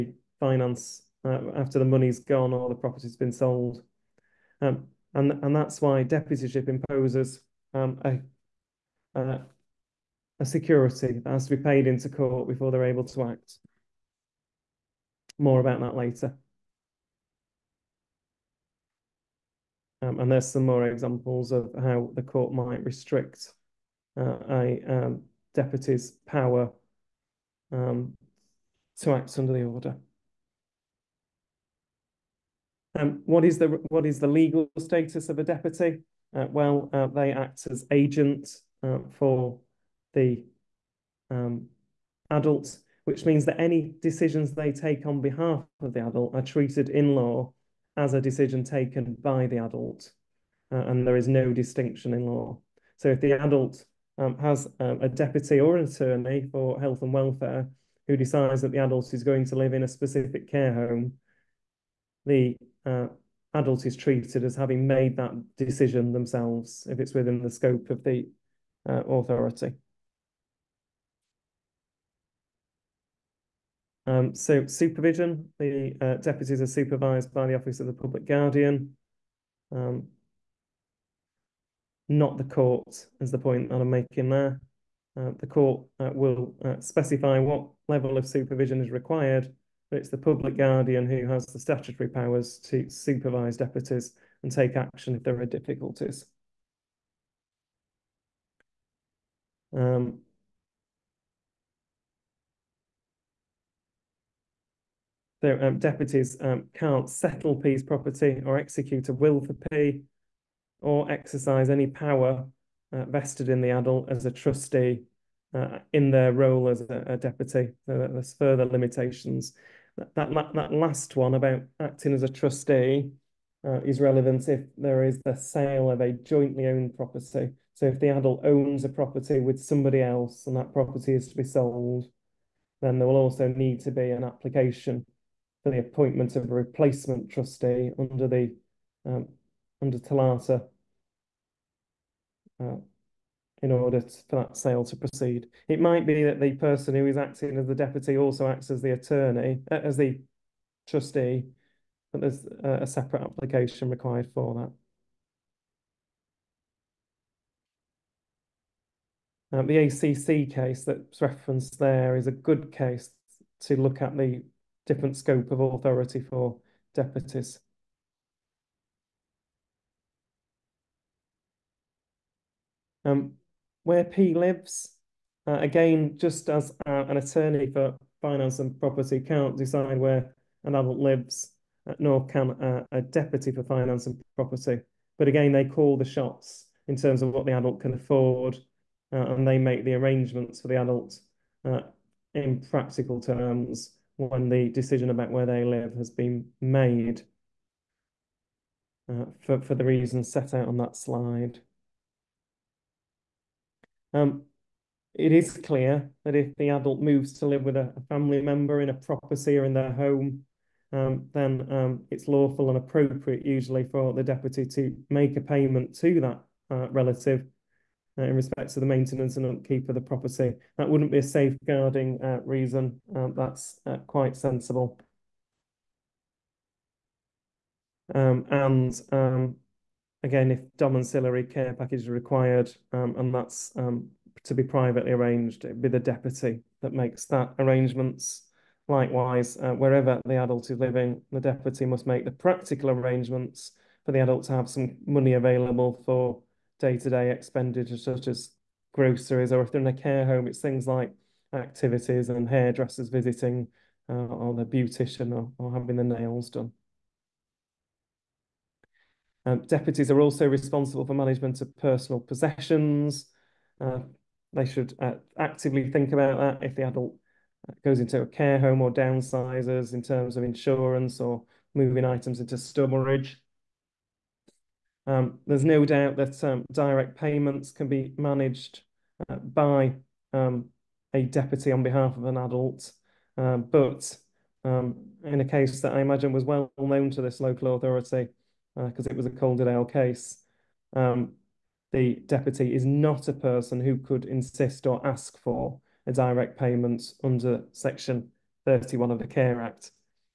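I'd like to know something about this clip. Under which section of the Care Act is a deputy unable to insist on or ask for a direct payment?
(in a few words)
Section 31.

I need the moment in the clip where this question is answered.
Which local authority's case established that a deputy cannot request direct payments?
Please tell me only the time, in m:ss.
4:49.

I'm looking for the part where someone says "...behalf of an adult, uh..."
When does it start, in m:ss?
4:41.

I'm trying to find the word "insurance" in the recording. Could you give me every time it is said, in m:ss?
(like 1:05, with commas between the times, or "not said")
4:30.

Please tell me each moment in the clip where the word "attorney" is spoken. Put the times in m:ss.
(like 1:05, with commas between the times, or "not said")
0:55, 2:28, 2:57.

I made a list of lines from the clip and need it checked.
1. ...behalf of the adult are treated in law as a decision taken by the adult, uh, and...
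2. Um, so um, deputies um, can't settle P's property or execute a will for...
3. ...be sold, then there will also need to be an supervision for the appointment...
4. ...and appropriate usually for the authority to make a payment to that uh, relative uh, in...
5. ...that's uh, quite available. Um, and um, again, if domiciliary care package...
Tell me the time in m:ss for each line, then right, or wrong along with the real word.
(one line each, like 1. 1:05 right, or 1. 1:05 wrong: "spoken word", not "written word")
1. 0:45 right
2. 1:39 right
3. 2:11 wrong: "application", not "supervision"
4. 3:32 wrong: "deputy", not "authority"
5. 3:43 wrong: "sensible", not "available".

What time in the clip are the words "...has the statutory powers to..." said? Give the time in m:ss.
1:31.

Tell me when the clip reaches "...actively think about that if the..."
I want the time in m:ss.
4:25.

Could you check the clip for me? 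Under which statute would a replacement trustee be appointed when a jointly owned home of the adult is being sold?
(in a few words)
TOLATA.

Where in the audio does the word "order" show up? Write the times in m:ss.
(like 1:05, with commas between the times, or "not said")
0:29, 2:23.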